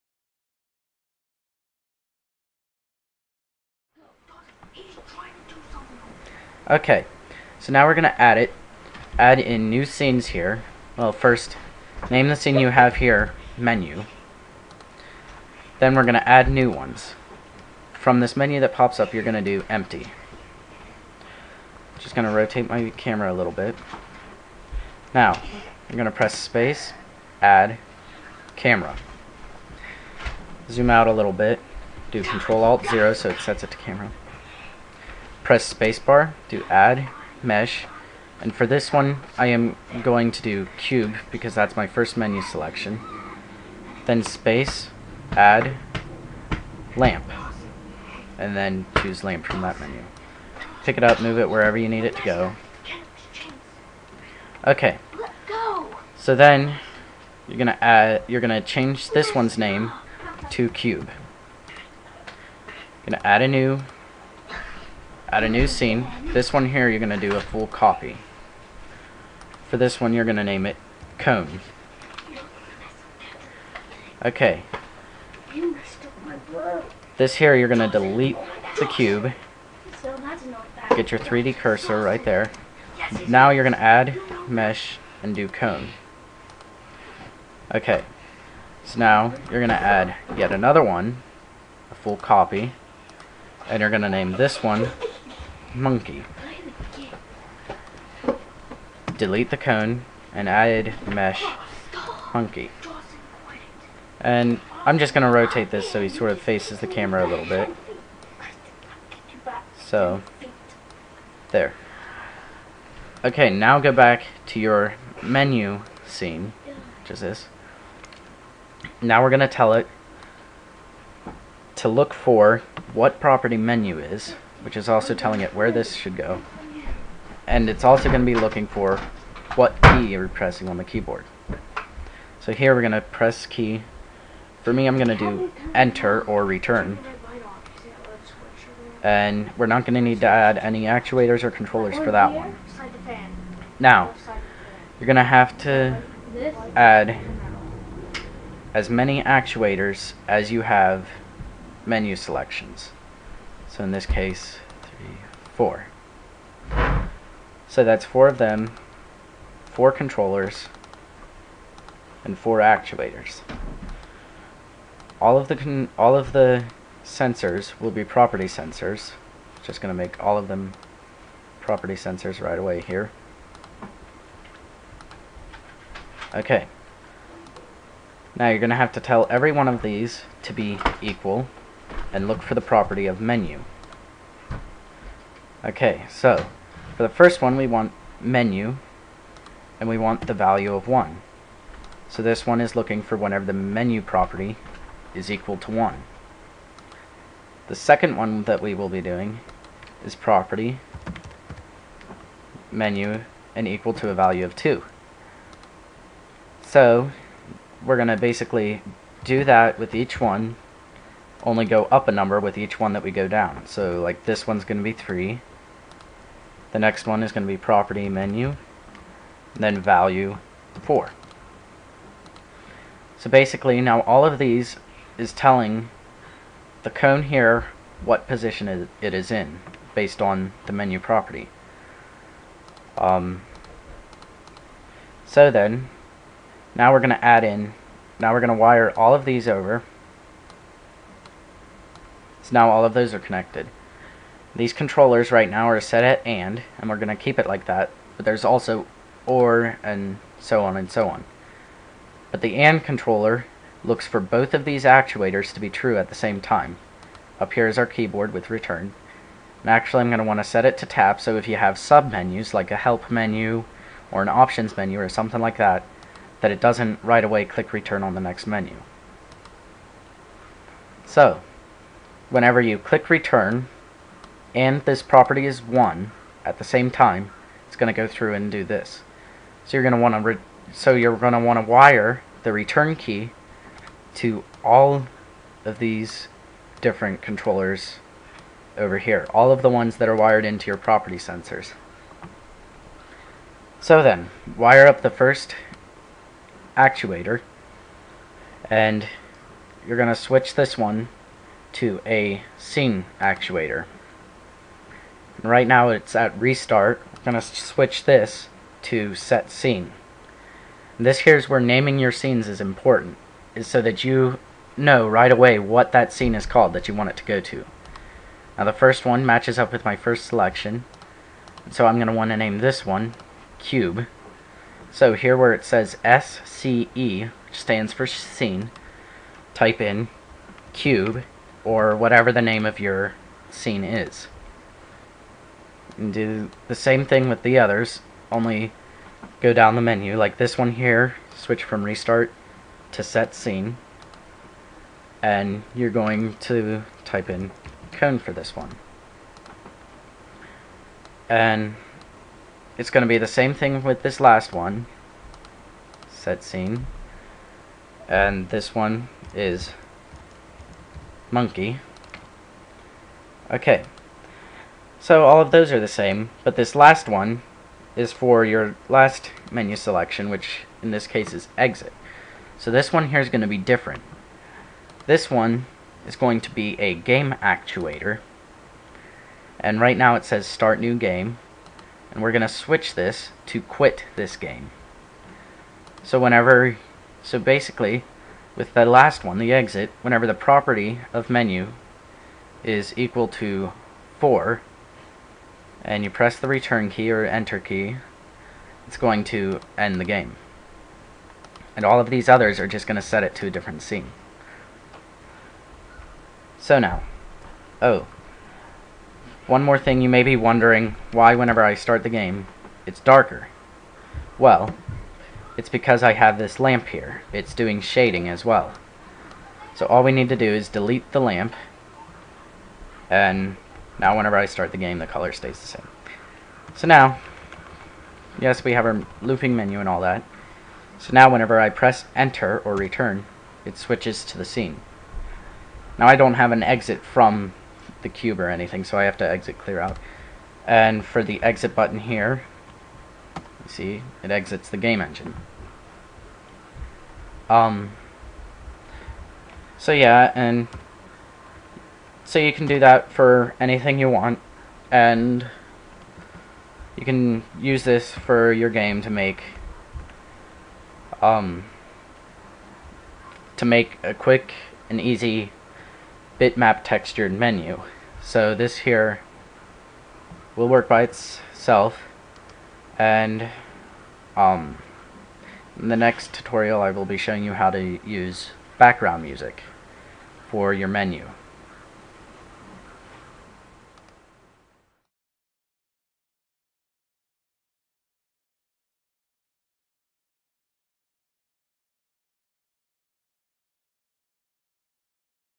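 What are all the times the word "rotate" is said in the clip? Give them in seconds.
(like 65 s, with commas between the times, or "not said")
22 s, 105 s.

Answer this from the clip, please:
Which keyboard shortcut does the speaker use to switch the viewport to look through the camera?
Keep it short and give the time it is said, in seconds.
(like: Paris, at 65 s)
Control Alt 0, at 32 s.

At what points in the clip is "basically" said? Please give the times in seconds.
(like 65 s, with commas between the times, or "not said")
208 s, 223 s, 387 s.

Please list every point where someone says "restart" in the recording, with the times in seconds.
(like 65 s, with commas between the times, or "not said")
306 s, 341 s.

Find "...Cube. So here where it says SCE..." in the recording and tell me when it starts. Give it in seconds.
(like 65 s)
323 s.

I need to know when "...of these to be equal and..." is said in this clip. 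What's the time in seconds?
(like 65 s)
179 s.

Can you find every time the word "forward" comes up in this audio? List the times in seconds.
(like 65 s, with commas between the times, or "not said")
not said.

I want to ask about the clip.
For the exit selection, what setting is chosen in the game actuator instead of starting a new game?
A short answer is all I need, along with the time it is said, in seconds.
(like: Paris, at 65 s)
quit this game, at 383 s.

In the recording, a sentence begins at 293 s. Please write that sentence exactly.
So then, wire up the first actuator and you're going to switch this one to a scene actuator.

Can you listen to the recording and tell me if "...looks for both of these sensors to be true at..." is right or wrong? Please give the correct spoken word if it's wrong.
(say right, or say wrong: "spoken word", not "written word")
wrong: "actuators", not "sensors".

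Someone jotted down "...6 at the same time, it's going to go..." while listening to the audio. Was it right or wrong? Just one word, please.
wrong.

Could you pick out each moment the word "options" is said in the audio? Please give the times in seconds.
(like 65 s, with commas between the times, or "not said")
264 s.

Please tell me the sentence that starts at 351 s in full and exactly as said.
And it's going to be the same thing with this last one, set scene, and this one is monkey.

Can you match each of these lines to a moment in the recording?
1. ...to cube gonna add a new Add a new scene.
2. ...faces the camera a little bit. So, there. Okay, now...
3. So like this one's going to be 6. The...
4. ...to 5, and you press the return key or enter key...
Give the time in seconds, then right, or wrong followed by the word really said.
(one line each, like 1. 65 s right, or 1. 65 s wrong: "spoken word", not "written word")
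1. 60 s right
2. 106 s right
3. 213 s wrong: "3", not "6"
4. 393 s wrong: "4", not "5".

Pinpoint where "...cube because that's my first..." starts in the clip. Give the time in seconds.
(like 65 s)
40 s.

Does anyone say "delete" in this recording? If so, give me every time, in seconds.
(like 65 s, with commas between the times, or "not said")
77 s, 99 s, 420 s.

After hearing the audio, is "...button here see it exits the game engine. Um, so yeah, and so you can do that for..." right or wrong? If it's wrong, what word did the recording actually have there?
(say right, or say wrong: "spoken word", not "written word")
right.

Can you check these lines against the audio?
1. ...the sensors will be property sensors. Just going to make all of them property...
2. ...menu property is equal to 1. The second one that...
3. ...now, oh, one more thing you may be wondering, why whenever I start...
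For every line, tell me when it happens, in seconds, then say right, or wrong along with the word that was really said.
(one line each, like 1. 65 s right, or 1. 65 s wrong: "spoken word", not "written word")
1. 166 s right
2. 193 s right
3. 406 s right.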